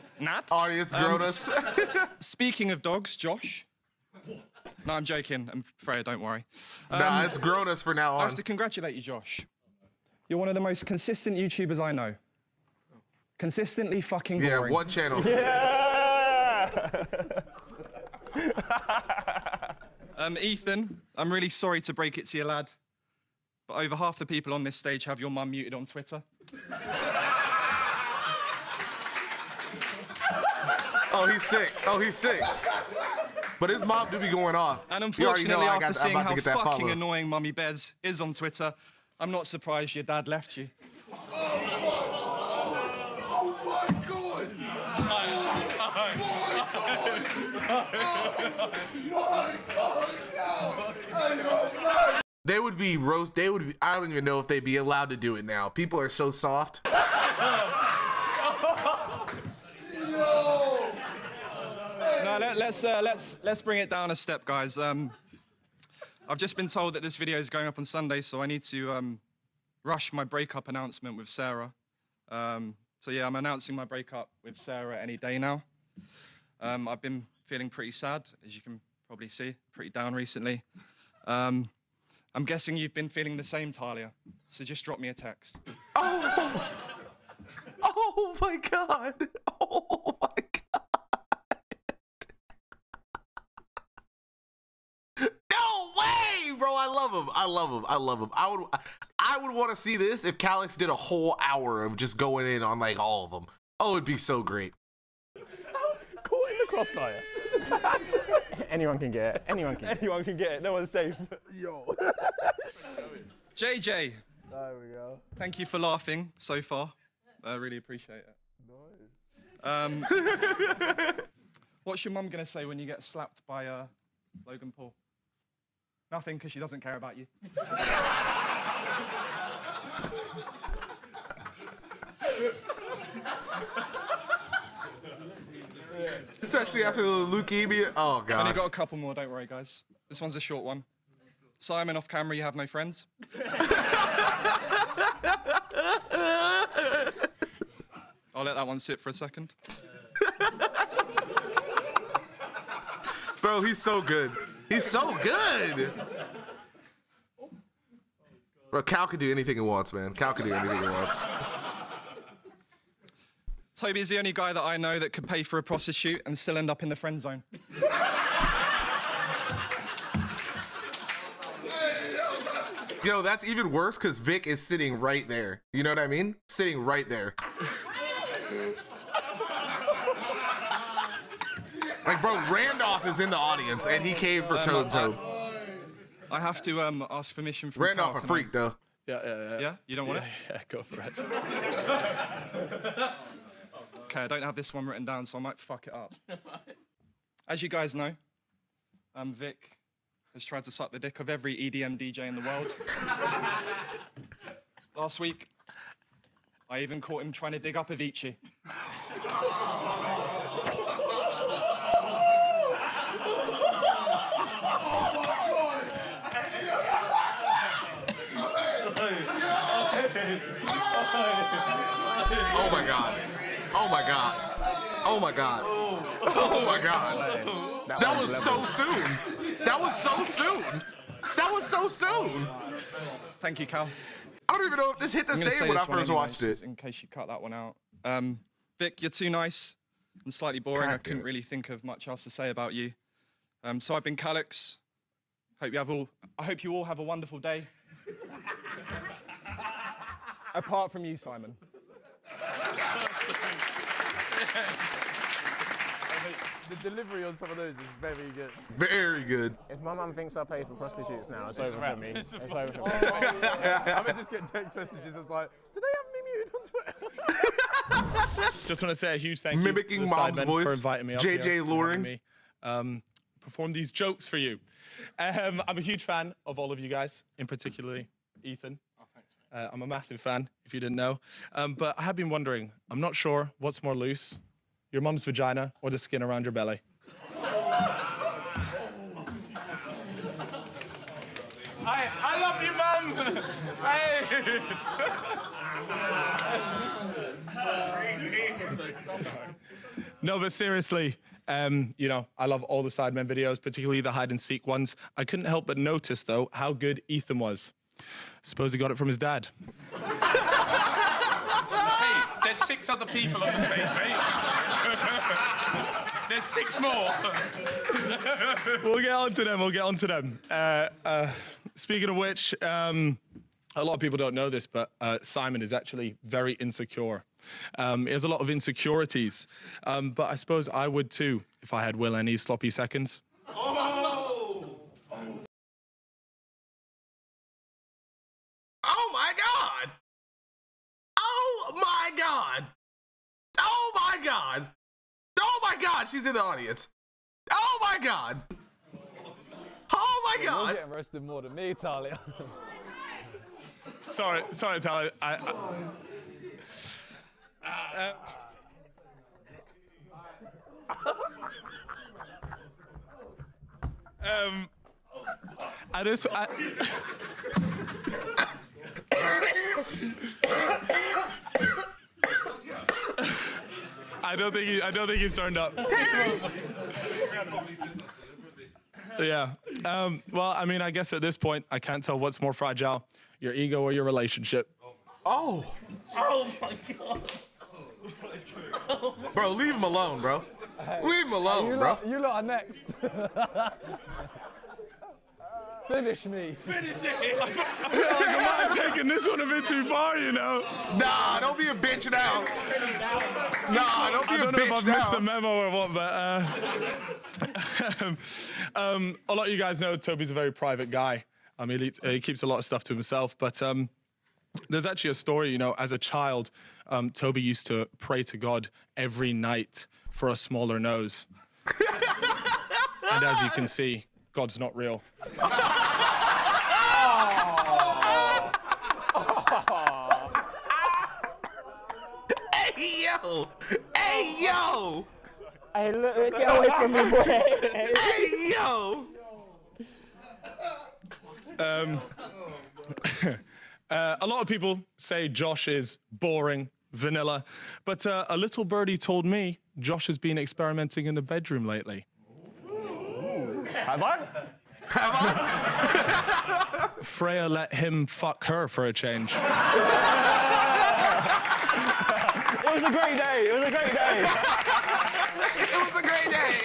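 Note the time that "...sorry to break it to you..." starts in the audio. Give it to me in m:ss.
0:21.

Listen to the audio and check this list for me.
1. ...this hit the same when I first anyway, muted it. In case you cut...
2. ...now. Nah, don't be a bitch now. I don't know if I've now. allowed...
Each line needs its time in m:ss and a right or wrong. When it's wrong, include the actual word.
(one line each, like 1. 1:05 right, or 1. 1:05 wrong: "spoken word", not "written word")
1. 3:54 wrong: "watched", not "muted"
2. 6:42 wrong: "missed", not "allowed".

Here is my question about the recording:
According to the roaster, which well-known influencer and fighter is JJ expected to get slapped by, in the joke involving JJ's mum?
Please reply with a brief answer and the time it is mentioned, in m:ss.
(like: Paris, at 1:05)
Logan Paul, at 2:04.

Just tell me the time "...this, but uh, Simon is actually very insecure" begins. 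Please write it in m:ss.
5:24.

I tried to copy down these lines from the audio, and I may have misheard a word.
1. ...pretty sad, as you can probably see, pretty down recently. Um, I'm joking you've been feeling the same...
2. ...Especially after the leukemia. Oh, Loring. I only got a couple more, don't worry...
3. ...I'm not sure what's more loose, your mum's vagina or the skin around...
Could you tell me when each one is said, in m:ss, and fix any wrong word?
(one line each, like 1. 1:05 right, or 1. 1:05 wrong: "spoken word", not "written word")
1. 1:17 wrong: "guessing", not "joking"
2. 2:16 wrong: "God", not "Loring"
3. 4:42 right.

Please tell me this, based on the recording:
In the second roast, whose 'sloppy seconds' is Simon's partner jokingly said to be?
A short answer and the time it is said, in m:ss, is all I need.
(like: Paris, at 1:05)
WillNE, at 5:31.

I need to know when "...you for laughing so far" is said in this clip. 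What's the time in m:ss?
1:55.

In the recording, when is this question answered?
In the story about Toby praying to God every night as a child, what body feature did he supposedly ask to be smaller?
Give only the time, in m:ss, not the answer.
7:00.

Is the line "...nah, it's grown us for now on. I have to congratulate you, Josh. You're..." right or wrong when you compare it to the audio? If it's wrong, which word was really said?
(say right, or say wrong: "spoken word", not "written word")
right.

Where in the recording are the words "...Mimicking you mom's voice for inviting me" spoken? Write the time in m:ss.
4:29.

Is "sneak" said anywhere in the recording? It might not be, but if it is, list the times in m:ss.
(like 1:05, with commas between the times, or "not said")
not said.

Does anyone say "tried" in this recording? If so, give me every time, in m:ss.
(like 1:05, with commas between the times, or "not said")
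3:20.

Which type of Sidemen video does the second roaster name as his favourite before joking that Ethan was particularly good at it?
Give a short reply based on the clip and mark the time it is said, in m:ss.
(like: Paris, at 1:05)
Hide and seek, at 5:04.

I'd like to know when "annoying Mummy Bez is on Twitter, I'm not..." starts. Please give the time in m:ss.
0:36.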